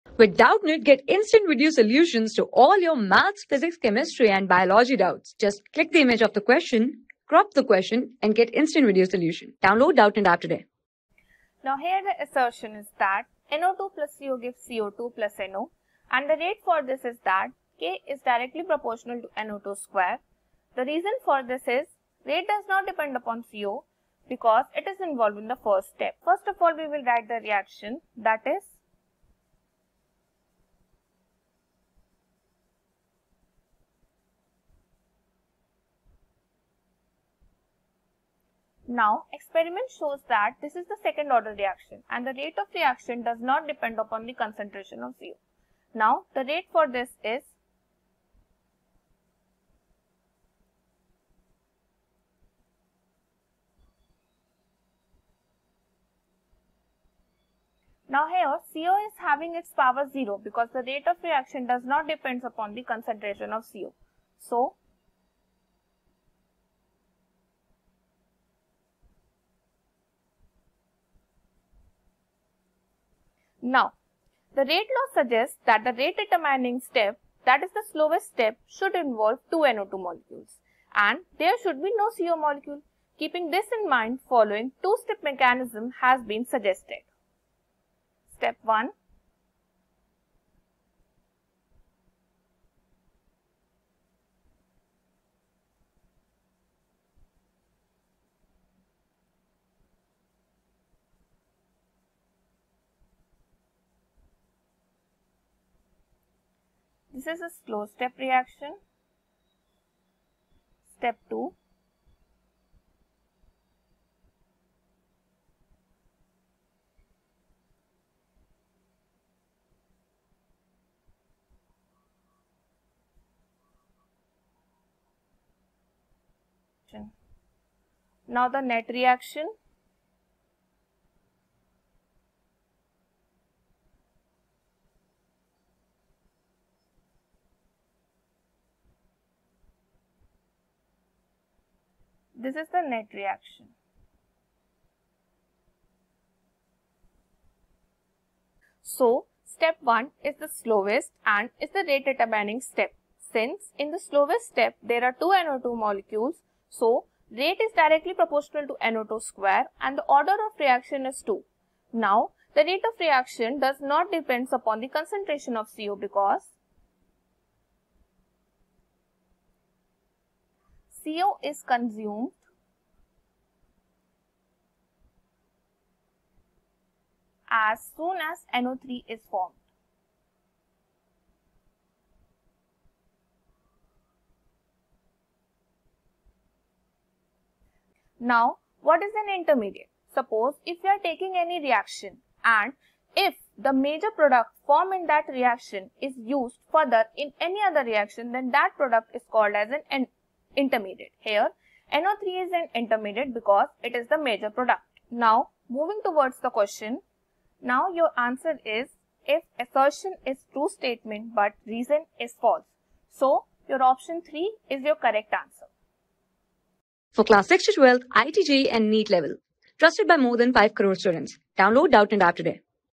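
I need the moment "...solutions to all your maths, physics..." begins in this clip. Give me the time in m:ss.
0:01.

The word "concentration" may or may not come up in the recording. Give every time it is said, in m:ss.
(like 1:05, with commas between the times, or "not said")
0:44, 1:02, 2:44.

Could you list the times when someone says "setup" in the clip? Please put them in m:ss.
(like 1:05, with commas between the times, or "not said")
not said.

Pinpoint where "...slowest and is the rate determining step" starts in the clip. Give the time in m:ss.
2:30.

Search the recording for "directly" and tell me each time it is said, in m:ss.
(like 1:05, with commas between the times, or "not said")
0:18, 2:37.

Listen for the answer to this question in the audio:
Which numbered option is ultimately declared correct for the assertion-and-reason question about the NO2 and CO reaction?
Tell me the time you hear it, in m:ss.
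3:33.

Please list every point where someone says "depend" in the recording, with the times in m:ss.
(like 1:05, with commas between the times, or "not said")
0:22, 0:43, 1:02, 2:44.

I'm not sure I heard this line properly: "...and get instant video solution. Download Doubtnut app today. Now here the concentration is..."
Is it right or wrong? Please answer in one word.
wrong.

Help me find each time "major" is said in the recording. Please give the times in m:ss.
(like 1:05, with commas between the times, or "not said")
3:13, 3:24.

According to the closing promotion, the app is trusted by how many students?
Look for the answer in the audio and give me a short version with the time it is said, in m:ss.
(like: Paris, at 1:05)
5 crore, at 3:40.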